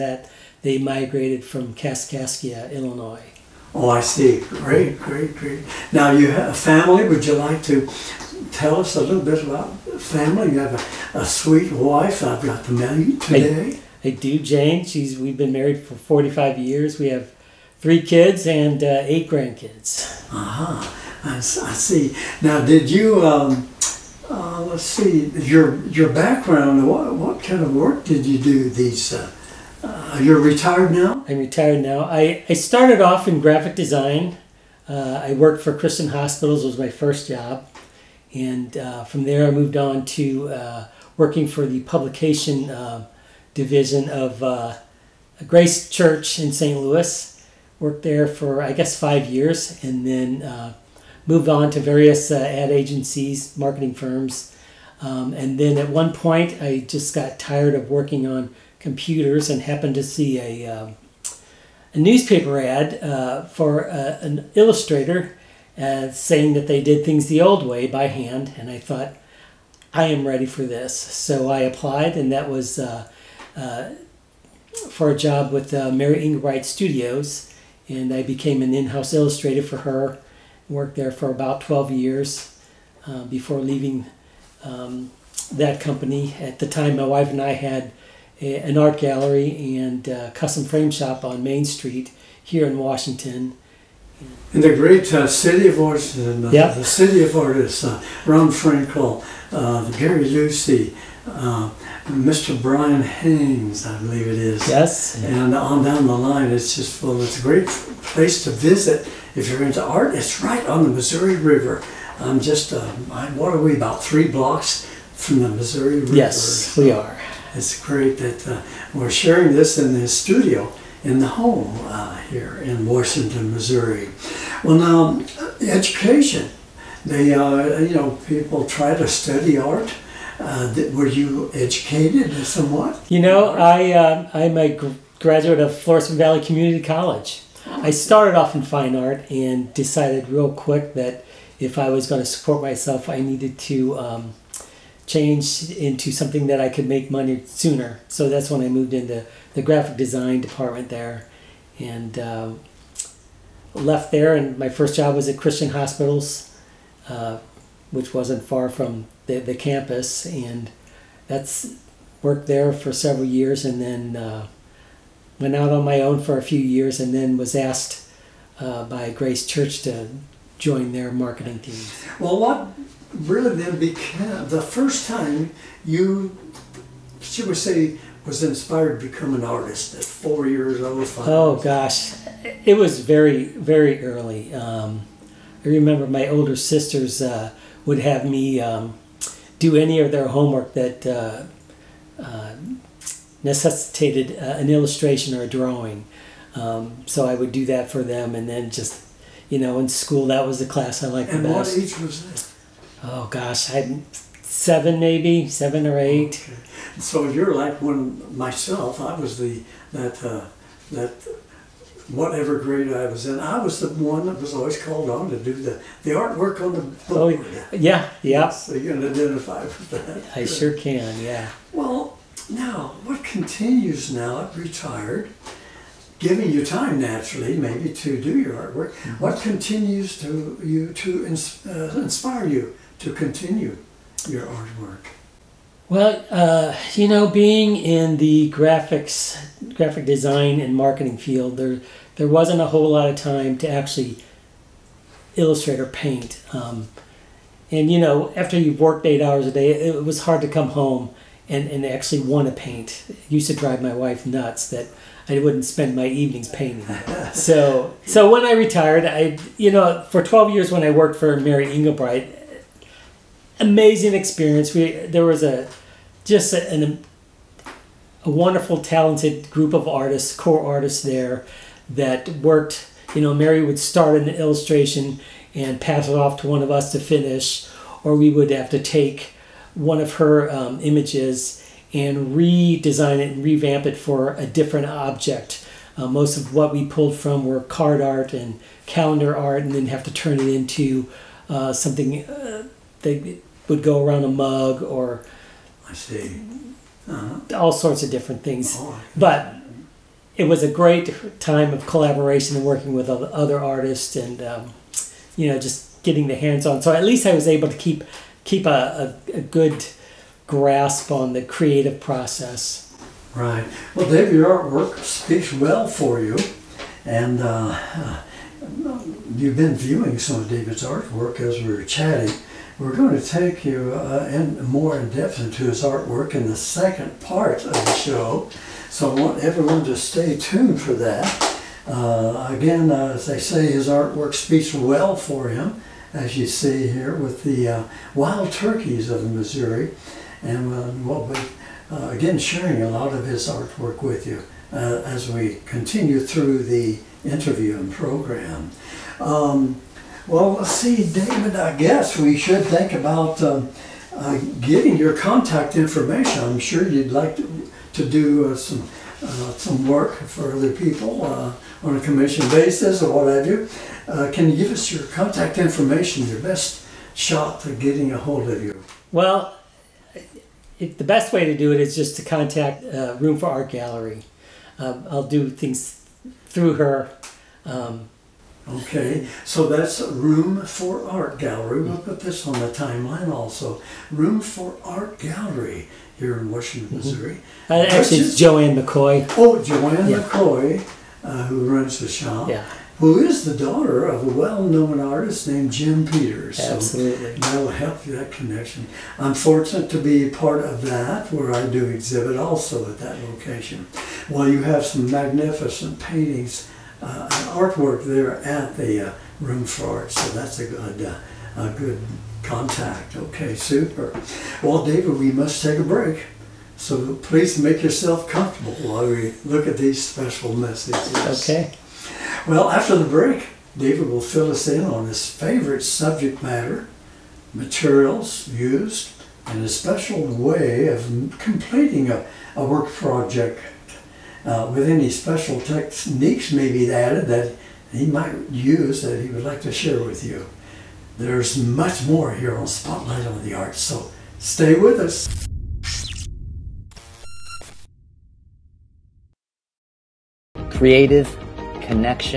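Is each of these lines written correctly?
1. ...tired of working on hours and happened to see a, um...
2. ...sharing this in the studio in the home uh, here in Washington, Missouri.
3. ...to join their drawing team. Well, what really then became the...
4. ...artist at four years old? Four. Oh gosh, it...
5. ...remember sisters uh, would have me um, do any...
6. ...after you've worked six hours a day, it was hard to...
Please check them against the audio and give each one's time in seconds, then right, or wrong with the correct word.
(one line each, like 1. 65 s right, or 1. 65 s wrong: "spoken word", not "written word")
1. 57 s wrong: "computers", not "hours"
2. 119 s right
3. 169 s wrong: "marketing", not "drawing"
4. 179 s wrong: "Five", not "Four"
5. 186 s wrong: "older", not "remember"
6. 248 s wrong: "eight", not "six".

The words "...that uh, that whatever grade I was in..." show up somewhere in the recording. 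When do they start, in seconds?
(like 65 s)
209 s.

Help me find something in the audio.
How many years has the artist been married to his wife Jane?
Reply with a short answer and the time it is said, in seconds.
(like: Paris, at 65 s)
45, at 15 s.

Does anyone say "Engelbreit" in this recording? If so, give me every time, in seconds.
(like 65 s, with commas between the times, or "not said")
76 s, 261 s.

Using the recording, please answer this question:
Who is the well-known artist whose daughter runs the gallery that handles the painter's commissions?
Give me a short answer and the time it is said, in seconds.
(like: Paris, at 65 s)
Jim Peters, at 395 s.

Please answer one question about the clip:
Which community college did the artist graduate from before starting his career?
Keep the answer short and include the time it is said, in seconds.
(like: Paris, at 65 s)
Florissant Valley Community College, at 135 s.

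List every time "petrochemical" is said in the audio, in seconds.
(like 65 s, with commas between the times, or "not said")
not said.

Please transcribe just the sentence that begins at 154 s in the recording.
And my first job was at Christian Hospitals, uh, which wasn't far from the, the campus.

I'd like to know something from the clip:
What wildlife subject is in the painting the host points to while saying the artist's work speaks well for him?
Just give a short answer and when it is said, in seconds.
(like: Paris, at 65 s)
Wild turkeys, at 338 s.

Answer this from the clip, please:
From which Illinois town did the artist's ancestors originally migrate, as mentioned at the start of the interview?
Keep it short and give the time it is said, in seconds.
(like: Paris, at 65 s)
Kaskaskia, at 1 s.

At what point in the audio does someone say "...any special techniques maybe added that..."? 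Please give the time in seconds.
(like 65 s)
434 s.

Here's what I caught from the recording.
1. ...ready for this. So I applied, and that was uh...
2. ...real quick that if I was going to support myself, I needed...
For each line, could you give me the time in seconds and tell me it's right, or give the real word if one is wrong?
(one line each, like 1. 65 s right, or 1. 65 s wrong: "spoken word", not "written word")
1. 70 s right
2. 140 s right.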